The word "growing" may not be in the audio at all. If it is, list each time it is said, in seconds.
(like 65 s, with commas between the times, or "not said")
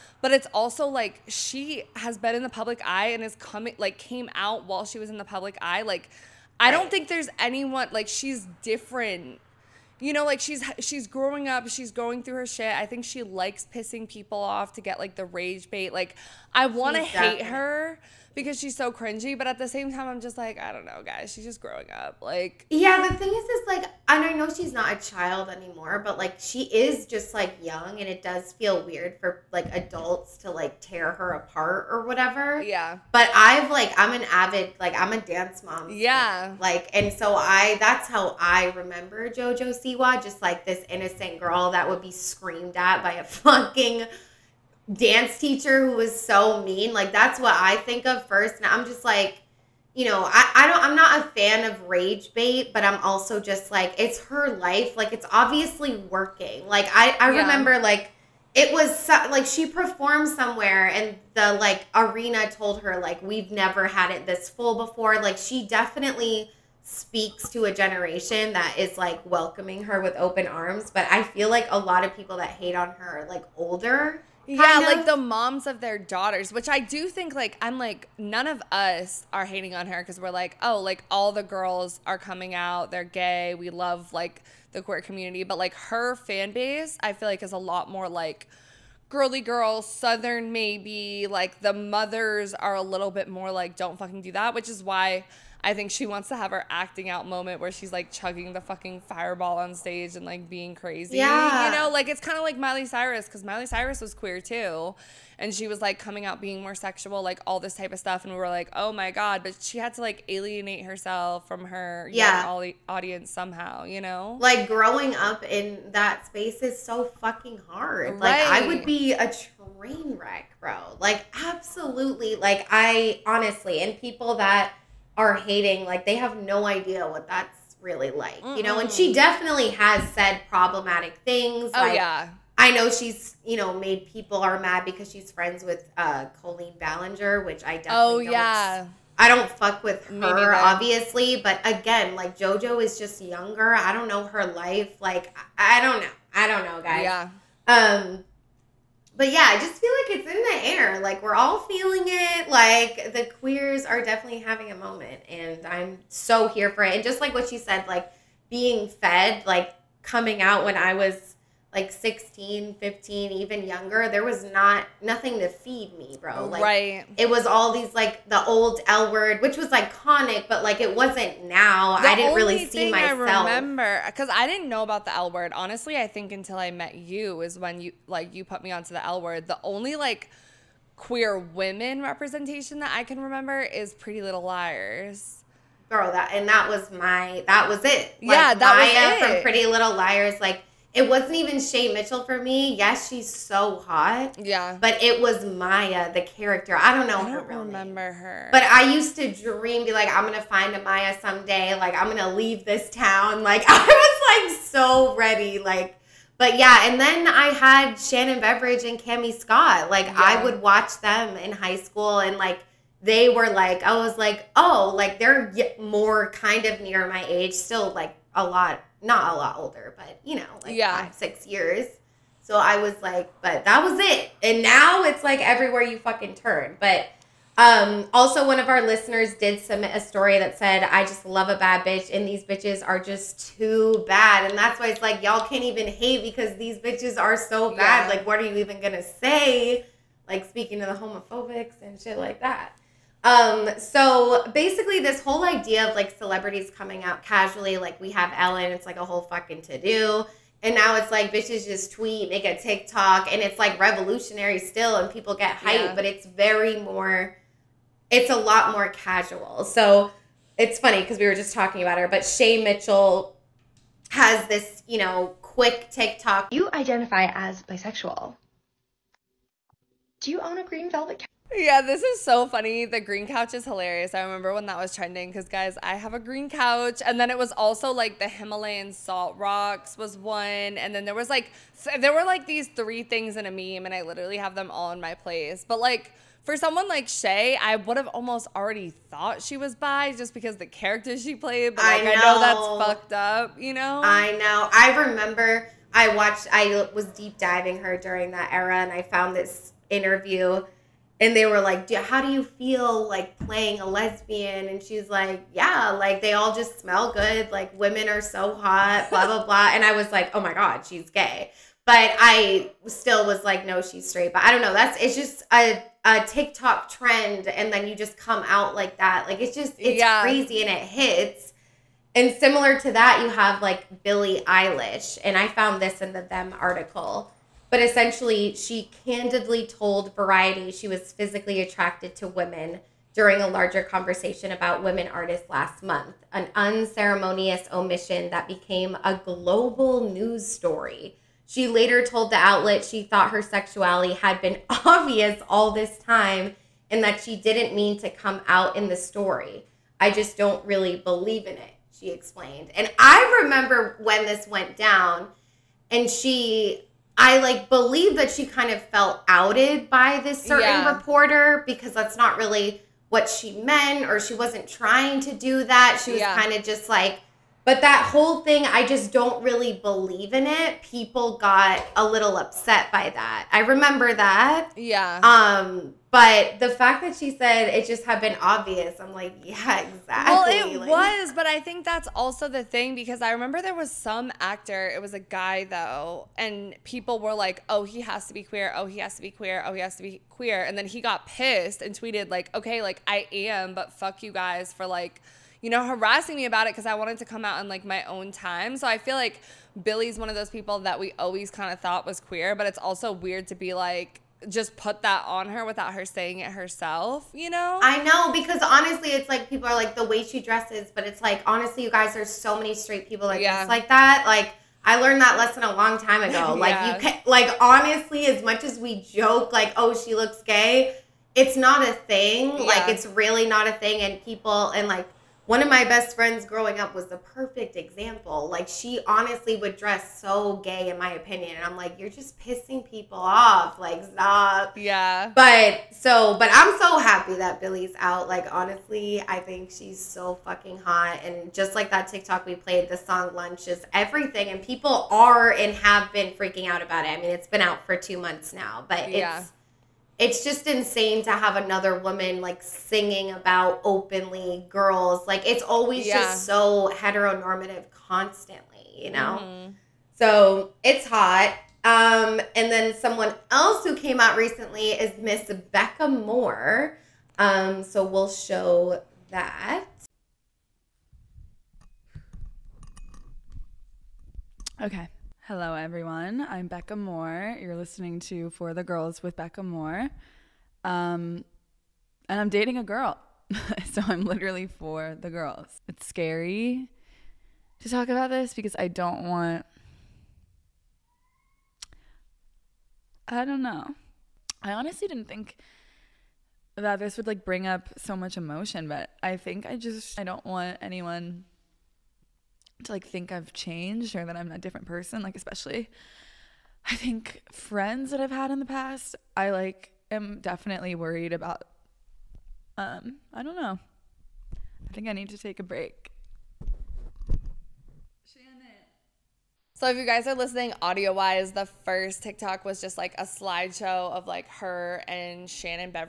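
11 s, 21 s, 114 s, 426 s.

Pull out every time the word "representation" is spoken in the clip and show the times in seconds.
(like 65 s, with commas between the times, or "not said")
182 s.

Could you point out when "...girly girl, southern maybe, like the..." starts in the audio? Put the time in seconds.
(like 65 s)
89 s.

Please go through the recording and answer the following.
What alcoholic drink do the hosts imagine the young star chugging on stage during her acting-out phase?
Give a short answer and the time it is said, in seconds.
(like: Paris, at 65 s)
Fireball, at 99 s.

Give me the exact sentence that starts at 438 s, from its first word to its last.
Like honestly, I think she's so fucking hot.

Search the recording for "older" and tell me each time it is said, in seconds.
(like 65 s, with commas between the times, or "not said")
73 s, 219 s.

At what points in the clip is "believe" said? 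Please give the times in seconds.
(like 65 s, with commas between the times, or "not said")
350 s, 357 s, 369 s.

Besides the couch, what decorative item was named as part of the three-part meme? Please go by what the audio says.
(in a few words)
Himalayan salt rocks.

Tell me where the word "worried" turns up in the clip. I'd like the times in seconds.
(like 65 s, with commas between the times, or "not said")
510 s.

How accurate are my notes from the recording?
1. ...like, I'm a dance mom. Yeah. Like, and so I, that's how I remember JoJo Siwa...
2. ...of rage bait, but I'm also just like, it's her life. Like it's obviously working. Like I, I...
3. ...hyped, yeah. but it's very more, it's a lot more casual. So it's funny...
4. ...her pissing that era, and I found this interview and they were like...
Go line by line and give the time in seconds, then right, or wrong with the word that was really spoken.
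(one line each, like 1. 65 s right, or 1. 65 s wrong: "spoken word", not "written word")
1. 34 s right
2. 51 s right
3. 255 s right
4. 297 s wrong: "during", not "pissing".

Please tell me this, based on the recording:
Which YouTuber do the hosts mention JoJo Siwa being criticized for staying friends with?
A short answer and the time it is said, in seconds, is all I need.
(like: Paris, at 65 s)
Colleen Ballinger, at 136 s.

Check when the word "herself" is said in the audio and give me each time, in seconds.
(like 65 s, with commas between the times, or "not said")
110 s, 406 s.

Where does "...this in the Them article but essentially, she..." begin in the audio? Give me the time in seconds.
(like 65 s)
325 s.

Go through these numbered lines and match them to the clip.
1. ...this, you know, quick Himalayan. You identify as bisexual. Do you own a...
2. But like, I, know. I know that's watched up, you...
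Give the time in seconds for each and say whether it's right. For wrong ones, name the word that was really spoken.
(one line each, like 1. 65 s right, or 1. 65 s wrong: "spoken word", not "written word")
1. 264 s wrong: "TikTok", not "Himalayan"
2. 291 s wrong: "fucked", not "watched".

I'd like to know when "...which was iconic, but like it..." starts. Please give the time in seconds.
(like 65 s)
169 s.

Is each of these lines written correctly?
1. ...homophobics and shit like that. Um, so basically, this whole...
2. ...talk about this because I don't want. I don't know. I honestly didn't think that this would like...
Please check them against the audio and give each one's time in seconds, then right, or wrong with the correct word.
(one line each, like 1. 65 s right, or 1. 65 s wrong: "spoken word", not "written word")
1. 240 s right
2. 487 s right.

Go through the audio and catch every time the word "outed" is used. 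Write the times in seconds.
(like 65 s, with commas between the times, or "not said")
359 s.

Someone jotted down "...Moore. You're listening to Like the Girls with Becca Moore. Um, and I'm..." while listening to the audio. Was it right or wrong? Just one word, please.
wrong.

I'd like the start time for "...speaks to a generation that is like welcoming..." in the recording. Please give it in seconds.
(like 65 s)
66 s.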